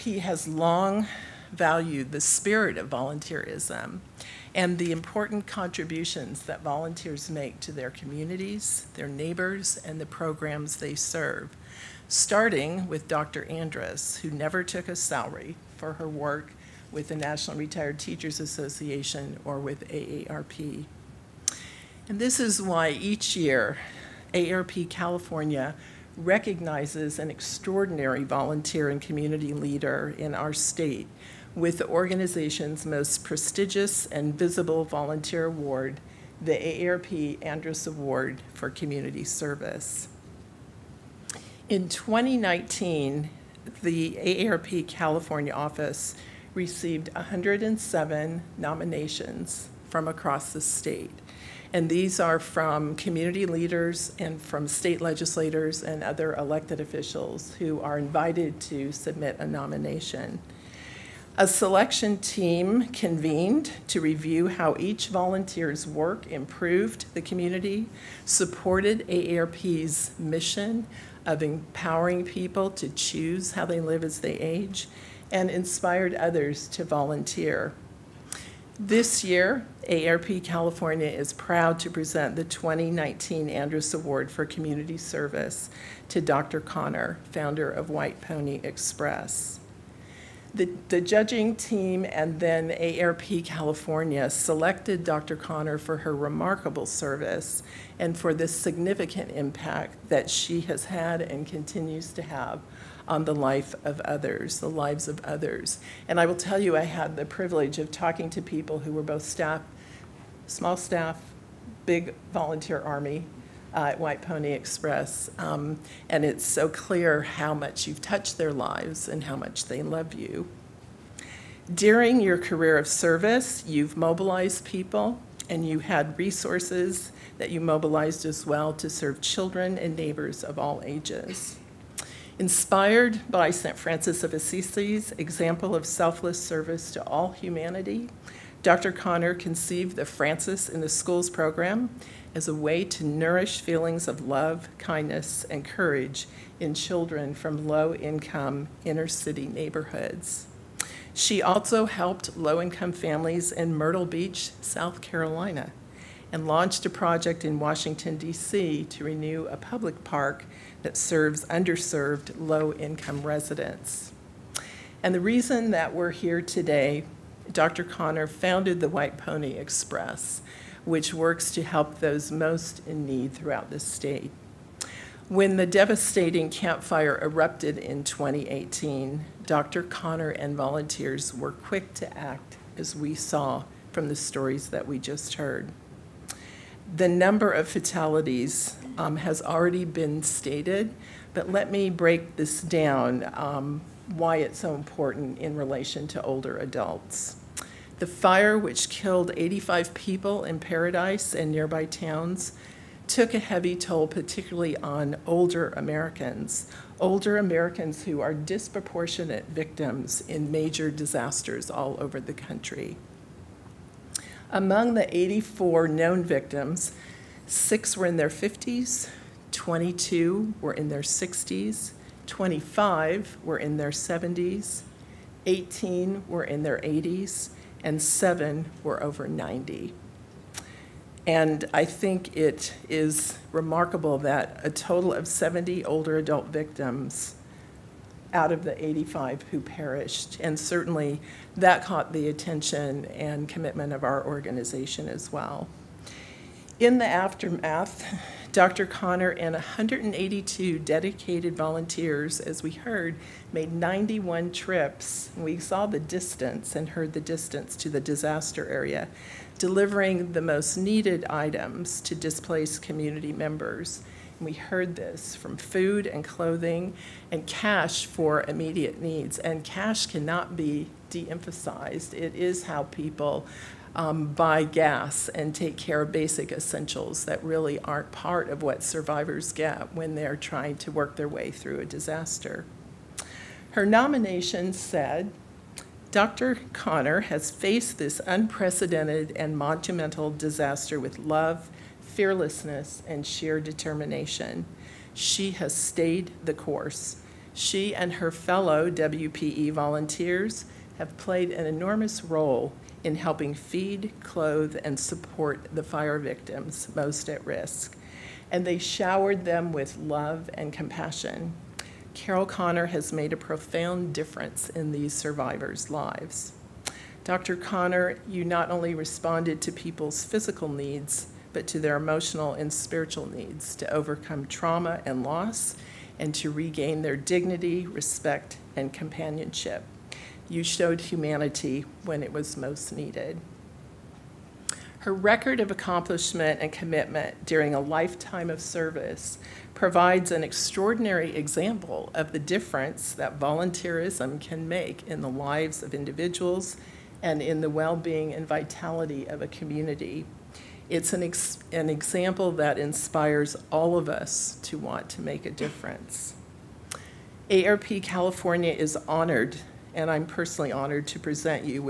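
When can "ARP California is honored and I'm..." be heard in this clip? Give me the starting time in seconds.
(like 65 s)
357 s.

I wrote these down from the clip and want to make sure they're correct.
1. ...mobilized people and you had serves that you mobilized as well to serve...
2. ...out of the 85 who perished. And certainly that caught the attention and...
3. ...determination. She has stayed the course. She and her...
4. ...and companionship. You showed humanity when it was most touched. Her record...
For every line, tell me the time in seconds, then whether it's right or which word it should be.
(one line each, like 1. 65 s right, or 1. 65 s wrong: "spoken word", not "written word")
1. 123 s wrong: "resources", not "serves"
2. 238 s right
3. 293 s right
4. 328 s wrong: "needed", not "touched".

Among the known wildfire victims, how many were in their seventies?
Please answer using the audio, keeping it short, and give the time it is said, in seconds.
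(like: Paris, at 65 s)
25, at 222 s.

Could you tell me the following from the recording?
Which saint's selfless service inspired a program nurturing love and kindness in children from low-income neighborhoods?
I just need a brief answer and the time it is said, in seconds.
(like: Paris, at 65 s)
St. Francis of Assisi, at 133 s.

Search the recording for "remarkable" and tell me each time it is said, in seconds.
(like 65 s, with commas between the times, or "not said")
96 s, 233 s.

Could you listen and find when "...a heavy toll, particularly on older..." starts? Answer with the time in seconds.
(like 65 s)
203 s.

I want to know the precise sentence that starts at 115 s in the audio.
Um, and it's so clear how much you've touched their lives and how much they love you.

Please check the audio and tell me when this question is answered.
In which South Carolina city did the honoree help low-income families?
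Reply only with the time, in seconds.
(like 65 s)
153 s.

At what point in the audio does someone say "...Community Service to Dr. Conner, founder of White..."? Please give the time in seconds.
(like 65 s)
84 s.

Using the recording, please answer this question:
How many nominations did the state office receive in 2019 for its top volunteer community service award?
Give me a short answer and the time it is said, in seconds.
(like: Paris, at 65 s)
107, at 47 s.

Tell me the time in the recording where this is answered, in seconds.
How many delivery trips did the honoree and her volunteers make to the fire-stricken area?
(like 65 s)
253 s.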